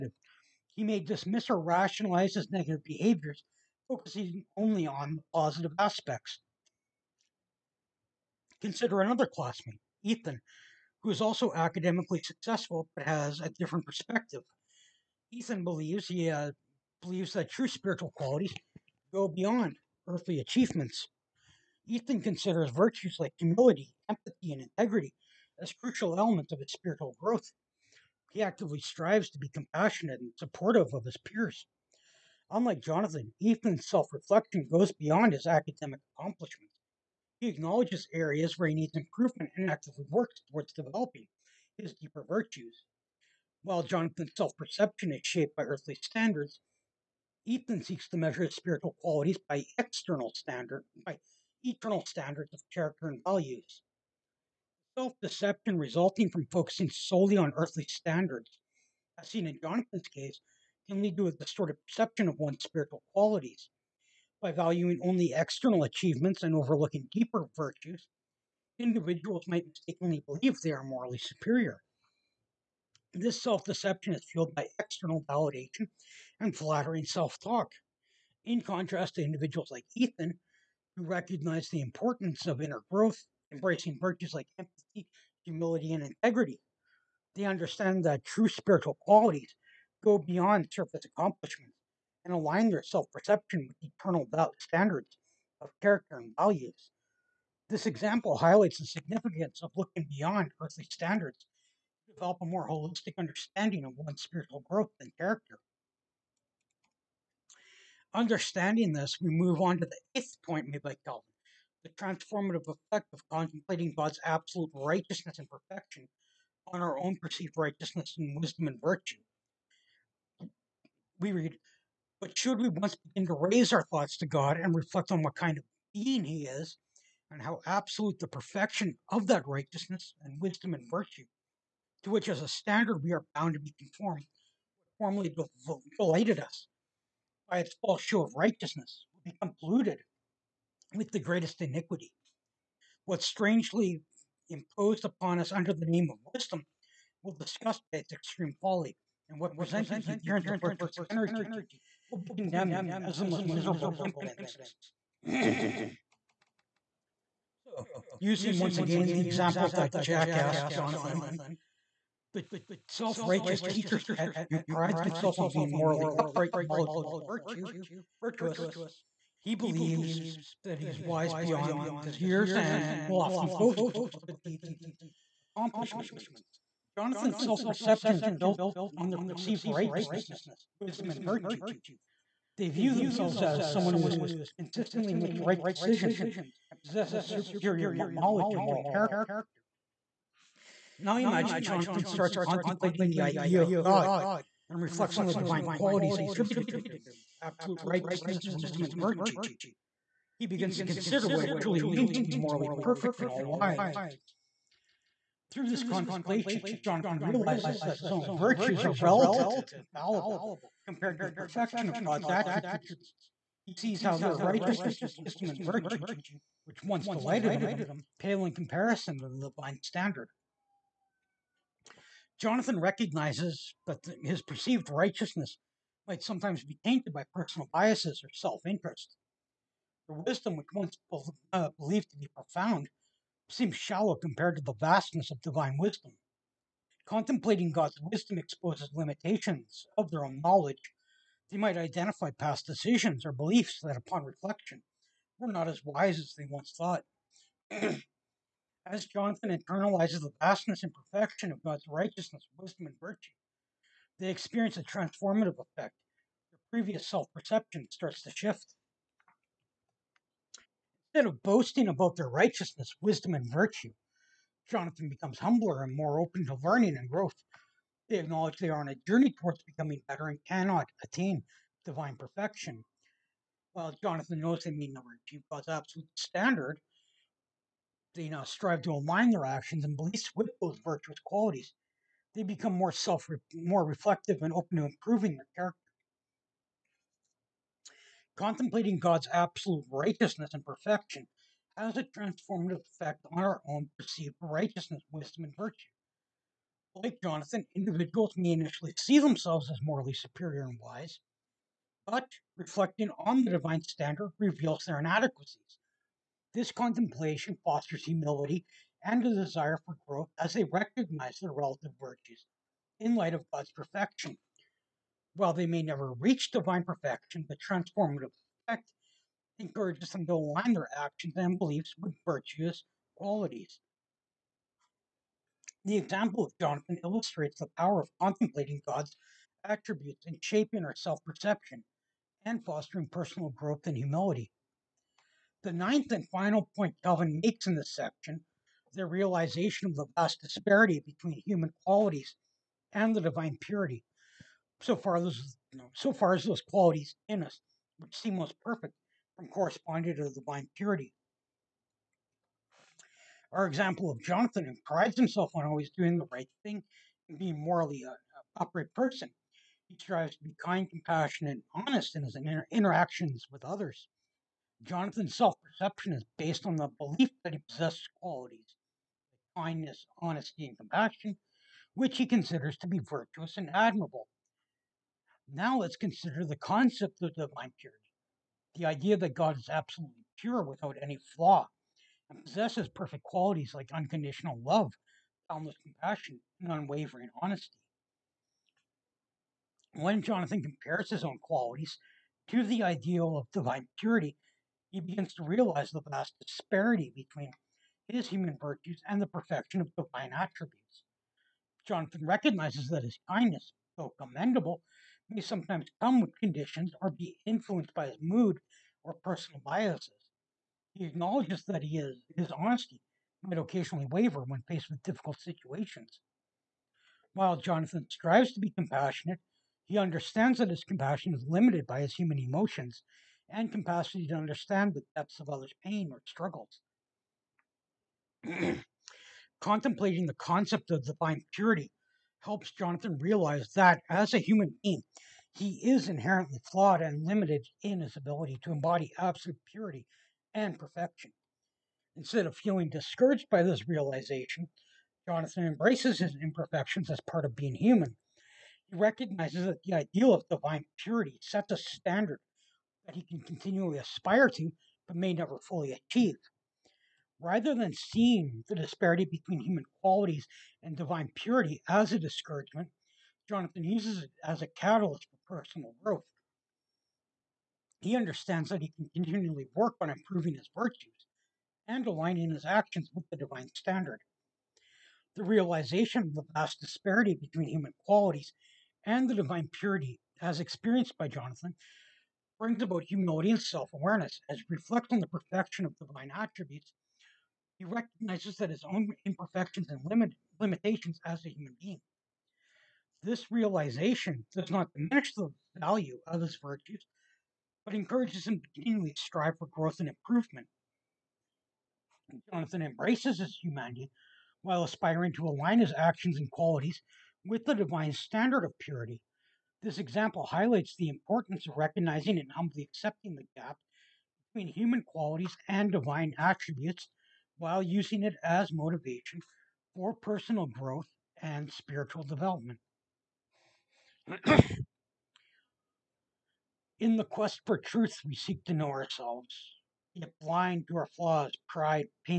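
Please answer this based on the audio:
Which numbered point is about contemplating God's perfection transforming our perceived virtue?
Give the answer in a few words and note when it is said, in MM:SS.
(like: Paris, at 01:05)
eighth, at 01:50.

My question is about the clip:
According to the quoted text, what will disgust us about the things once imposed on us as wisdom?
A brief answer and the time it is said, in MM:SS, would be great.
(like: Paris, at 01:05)
its extreme folly, at 02:27.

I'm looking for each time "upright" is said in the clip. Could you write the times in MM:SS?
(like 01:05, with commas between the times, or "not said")
02:46, 05:58.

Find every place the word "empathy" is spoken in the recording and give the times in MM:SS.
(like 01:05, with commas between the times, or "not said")
00:24, 01:24.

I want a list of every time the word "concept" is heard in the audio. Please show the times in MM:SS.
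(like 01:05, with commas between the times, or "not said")
06:16, 07:10.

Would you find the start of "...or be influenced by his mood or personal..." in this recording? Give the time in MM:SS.
06:47.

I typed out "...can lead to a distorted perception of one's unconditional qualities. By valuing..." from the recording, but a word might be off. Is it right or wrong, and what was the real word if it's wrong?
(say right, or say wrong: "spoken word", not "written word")
wrong: "spiritual", not "unconditional".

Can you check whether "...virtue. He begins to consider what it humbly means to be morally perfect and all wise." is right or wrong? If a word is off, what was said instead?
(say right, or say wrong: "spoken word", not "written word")
wrong: "truly", not "humbly".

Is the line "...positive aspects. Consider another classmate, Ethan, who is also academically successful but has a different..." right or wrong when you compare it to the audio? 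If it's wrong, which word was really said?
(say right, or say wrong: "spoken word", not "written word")
right.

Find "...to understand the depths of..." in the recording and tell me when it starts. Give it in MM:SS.
07:04.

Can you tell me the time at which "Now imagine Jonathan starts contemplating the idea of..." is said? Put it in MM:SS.
03:10.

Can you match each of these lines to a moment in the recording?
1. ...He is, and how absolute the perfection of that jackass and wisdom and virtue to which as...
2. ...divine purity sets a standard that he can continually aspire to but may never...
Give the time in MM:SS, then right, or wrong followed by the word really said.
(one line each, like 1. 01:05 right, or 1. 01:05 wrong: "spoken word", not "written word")
1. 02:06 wrong: "righteousness", not "jackass"
2. 07:30 right.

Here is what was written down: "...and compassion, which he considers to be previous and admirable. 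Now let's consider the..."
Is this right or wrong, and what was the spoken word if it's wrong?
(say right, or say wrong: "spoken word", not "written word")
wrong: "virtuous", not "previous".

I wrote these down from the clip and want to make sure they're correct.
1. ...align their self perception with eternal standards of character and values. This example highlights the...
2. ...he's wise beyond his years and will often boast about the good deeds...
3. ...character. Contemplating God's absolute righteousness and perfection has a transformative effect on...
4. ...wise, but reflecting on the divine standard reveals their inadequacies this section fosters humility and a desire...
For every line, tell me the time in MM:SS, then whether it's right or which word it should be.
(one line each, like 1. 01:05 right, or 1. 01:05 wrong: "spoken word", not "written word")
1. 01:32 right
2. 02:50 right
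3. 04:45 right
4. 05:00 wrong: "contemplation", not "section".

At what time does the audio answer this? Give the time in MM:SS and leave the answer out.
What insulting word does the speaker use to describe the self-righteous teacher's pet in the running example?
02:39.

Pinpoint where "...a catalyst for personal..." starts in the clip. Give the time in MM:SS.
07:44.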